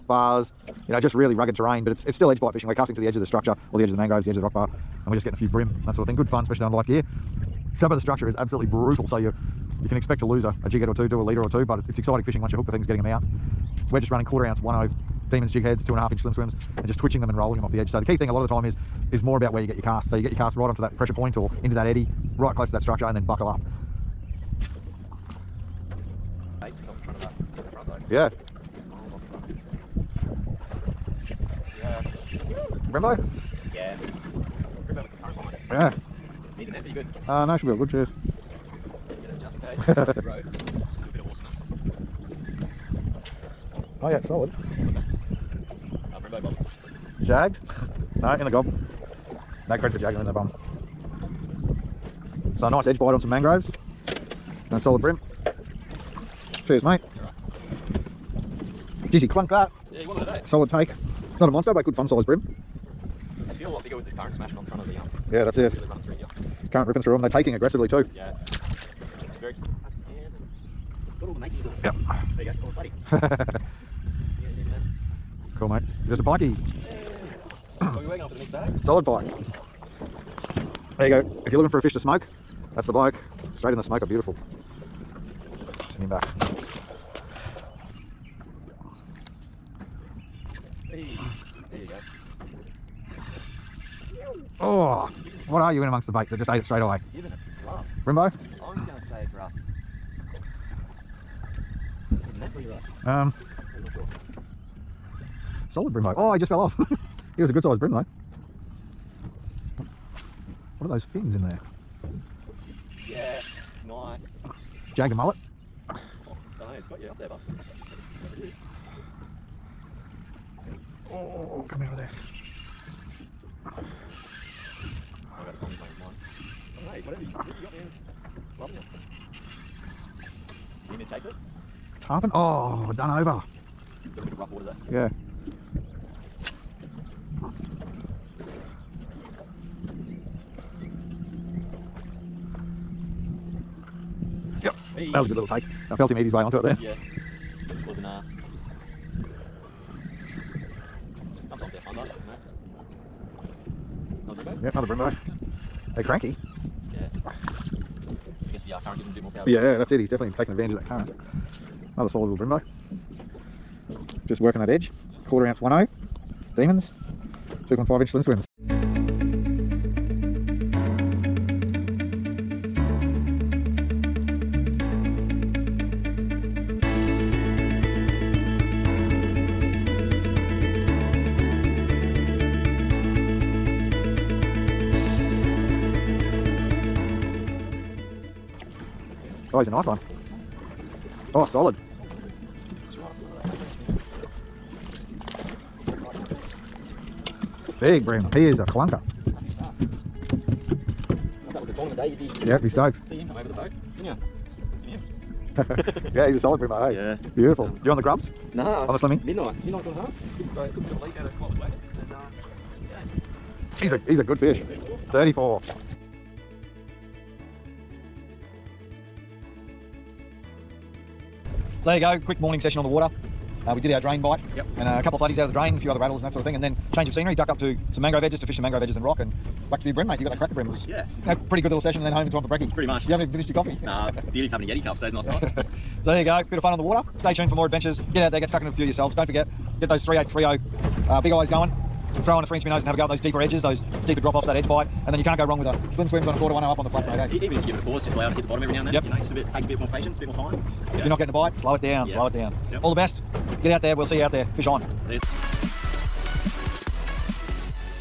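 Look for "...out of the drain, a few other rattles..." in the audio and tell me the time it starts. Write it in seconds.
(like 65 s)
225 s.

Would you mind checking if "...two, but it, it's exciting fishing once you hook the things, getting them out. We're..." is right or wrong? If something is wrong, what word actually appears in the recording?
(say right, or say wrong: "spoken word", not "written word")
right.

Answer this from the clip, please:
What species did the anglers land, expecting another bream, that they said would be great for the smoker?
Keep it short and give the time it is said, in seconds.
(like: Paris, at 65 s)
Pike, at 76 s.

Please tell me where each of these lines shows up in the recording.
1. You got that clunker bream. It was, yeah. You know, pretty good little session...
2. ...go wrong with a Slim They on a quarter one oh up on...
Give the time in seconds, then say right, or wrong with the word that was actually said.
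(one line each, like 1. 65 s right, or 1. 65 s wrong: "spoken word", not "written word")
1. 230 s wrong: "cracker", not "clunker"
2. 245 s wrong: "SwimZ", not "They".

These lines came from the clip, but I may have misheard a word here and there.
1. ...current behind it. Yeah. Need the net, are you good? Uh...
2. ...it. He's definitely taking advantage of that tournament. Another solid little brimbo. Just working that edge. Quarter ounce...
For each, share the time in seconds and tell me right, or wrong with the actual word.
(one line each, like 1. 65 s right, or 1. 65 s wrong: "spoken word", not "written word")
1. 35 s right
2. 159 s wrong: "current", not "tournament".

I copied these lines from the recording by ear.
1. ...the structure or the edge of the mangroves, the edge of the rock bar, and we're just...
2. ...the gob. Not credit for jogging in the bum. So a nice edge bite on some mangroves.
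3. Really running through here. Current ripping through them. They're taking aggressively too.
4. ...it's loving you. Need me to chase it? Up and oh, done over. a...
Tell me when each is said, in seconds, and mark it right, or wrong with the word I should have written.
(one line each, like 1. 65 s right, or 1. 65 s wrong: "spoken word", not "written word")
1. 3 s right
2. 48 s right
3. 65 s right
4. 127 s right.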